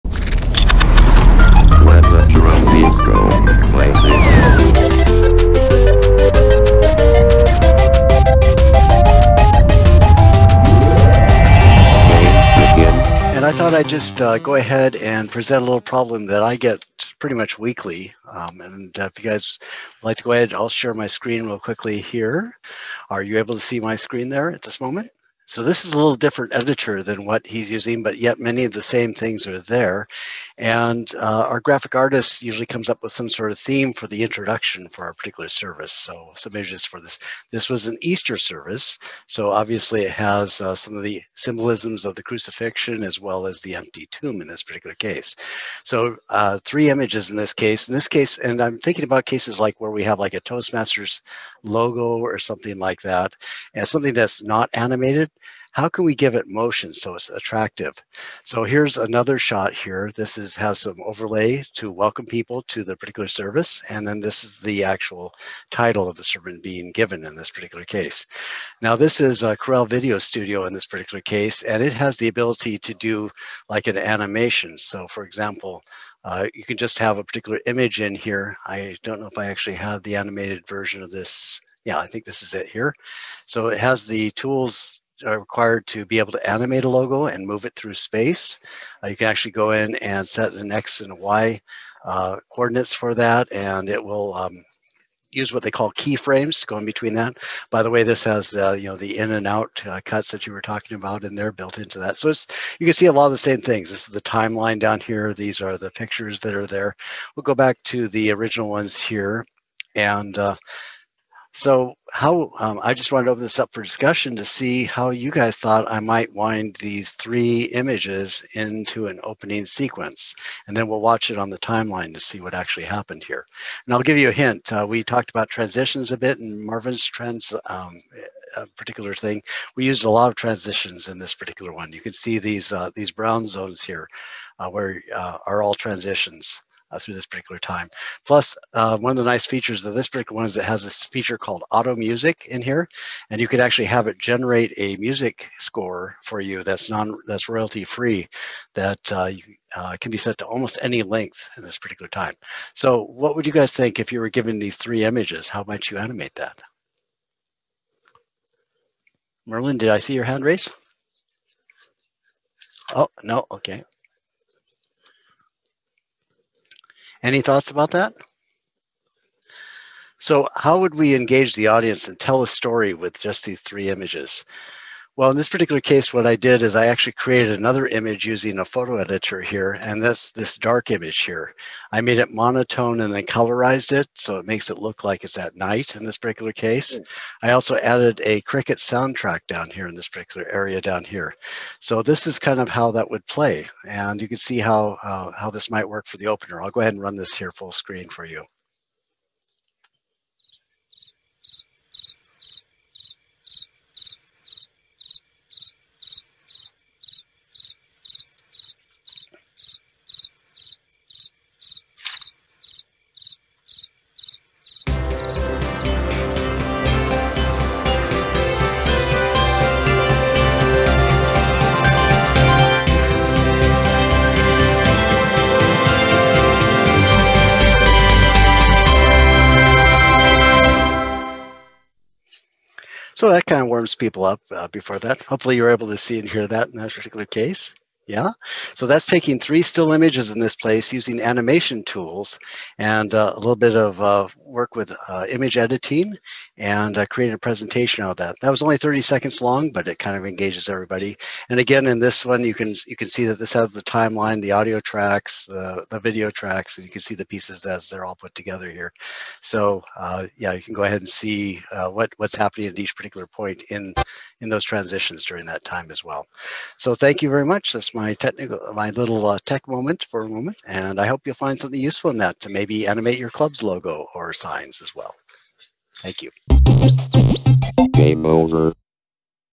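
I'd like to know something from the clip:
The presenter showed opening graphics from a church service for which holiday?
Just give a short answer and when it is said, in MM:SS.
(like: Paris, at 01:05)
Easter, at 00:37.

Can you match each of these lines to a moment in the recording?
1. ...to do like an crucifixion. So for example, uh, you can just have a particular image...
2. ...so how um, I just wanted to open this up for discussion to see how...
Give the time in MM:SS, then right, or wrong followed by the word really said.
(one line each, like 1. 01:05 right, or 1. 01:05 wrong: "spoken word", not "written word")
1. 01:12 wrong: "animation", not "crucifixion"
2. 01:51 right.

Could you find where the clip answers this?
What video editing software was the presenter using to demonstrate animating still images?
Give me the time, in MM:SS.
01:09.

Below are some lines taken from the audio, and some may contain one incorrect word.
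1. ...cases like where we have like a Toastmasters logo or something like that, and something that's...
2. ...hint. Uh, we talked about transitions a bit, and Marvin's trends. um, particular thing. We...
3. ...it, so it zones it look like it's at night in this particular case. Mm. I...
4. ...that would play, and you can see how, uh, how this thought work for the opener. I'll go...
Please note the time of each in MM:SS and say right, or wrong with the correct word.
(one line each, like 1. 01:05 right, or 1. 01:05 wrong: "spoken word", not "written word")
1. 00:49 right
2. 02:04 right
3. 03:03 wrong: "makes", not "zones"
4. 03:12 wrong: "might", not "thought".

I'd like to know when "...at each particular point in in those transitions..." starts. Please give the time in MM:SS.
04:22.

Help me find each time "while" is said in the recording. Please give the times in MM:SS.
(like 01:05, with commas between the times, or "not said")
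not said.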